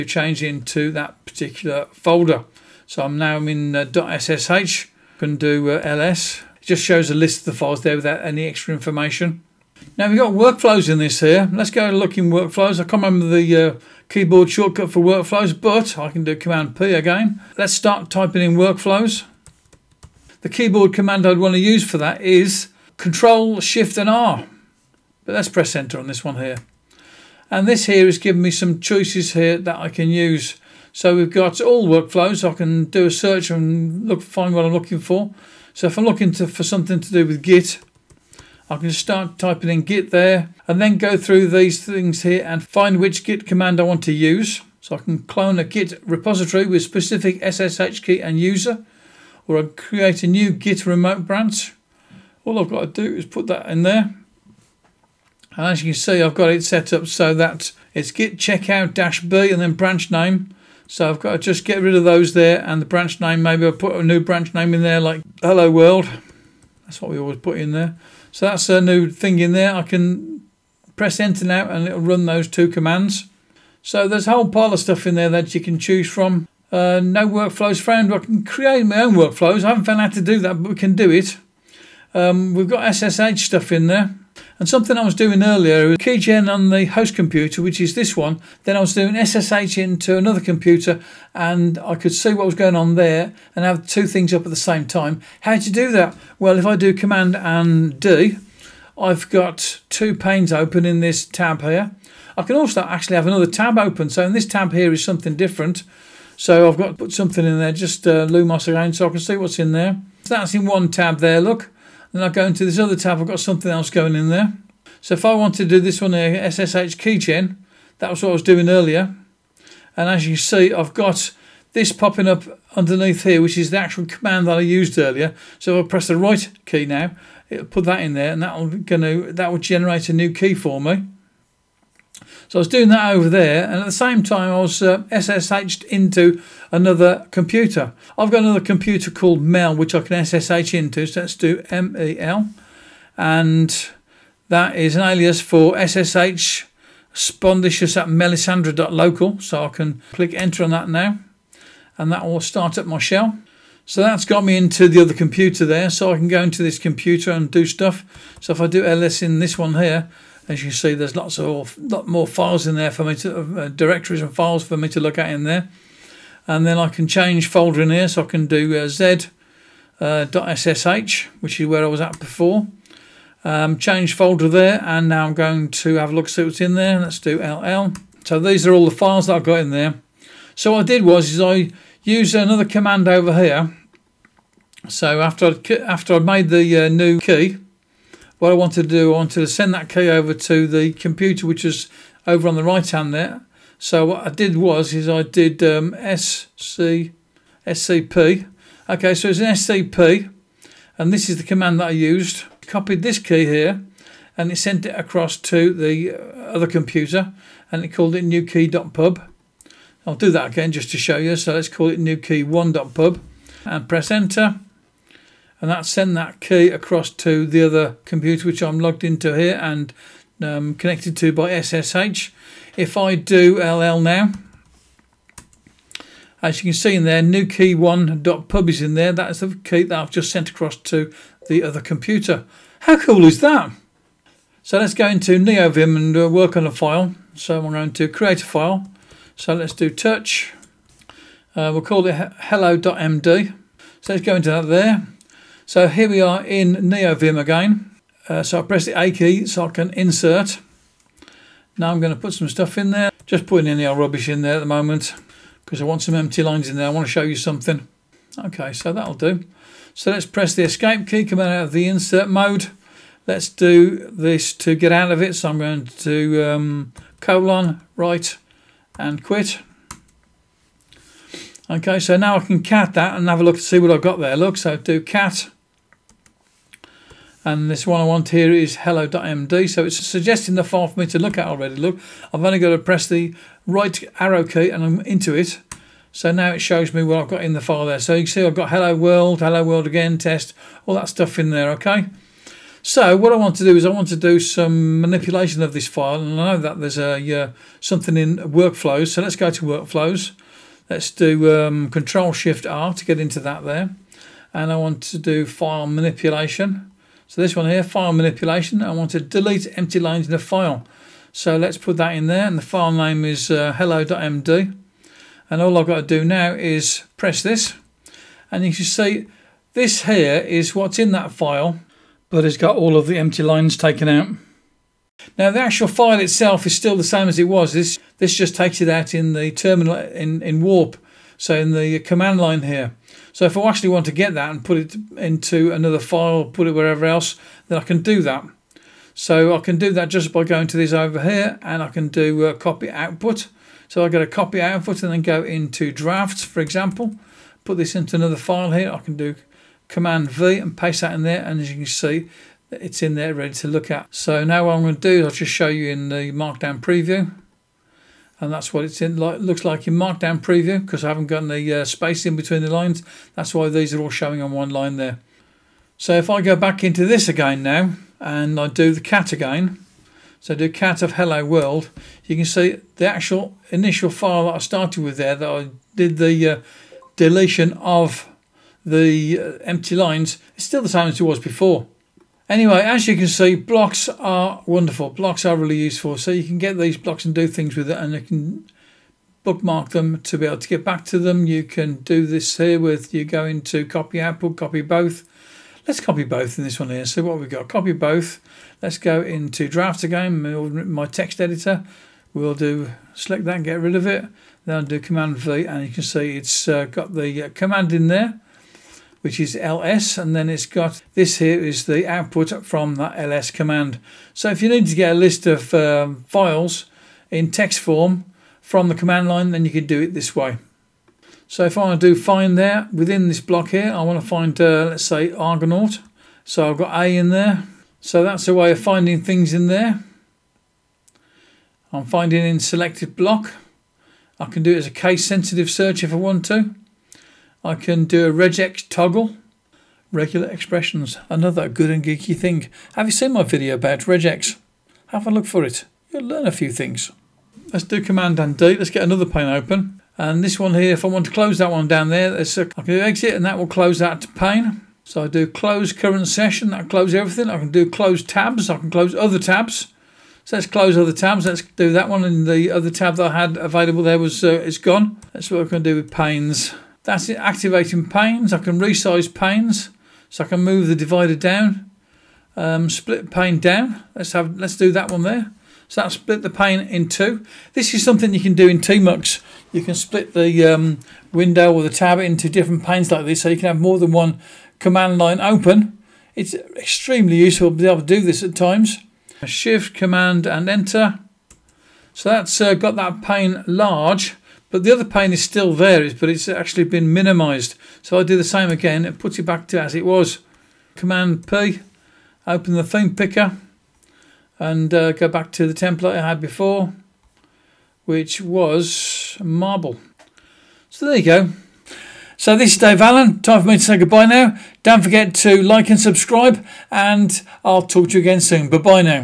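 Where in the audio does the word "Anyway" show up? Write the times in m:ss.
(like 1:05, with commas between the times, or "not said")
6:22.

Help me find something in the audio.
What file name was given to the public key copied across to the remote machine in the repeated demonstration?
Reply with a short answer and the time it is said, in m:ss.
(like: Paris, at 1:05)
newkey1.pub, at 3:31.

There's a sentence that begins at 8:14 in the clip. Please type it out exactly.
But the other pane is still there, but it's actually been minimized.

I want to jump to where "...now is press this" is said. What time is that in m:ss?
5:16.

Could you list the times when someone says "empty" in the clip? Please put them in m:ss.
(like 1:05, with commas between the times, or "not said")
4:16, 5:09, 5:23, 6:19.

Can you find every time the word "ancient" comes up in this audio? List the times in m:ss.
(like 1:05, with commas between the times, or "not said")
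not said.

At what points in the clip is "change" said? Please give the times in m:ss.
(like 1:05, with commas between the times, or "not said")
0:00, 2:47, 2:53.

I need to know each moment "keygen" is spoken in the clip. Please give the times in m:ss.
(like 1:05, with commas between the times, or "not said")
1:25, 1:56.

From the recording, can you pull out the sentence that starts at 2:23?
And that is an alias for SSH spondicious at melisandre.local.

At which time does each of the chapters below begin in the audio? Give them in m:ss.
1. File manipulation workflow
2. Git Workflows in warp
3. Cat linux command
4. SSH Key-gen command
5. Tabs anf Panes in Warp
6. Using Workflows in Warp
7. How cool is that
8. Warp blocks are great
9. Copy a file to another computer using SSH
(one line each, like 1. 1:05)
1. 5:07
2. 0:53
3. 4:35
4. 2:10
5. 1:55
6. 0:18
7. 3:52
8. 6:26
9. 3:07.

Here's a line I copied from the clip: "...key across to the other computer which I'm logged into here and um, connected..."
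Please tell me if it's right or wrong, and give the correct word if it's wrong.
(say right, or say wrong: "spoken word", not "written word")
right.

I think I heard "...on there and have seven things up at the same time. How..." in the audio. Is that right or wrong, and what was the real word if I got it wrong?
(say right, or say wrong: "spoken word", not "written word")
wrong: "two", not "seven".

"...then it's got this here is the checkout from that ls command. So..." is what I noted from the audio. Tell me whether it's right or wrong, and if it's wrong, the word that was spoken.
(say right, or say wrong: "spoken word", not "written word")
wrong: "output", not "checkout".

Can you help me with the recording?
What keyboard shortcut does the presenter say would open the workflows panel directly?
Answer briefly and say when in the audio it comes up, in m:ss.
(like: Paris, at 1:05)
Control Shift R, at 0:22.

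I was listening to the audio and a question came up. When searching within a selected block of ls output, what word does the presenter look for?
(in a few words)
Argonaut.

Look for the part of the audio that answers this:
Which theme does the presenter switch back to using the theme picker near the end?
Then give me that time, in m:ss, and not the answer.
8:29.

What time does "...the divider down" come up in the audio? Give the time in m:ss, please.
7:50.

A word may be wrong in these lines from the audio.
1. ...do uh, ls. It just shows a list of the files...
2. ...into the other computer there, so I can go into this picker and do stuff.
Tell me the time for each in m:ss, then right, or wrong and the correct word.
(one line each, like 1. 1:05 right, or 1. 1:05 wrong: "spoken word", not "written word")
1. 0:05 right
2. 2:34 wrong: "computer", not "picker".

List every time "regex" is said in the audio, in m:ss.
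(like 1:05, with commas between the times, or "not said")
7:18, 7:23.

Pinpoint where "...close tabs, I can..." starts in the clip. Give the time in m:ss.
7:37.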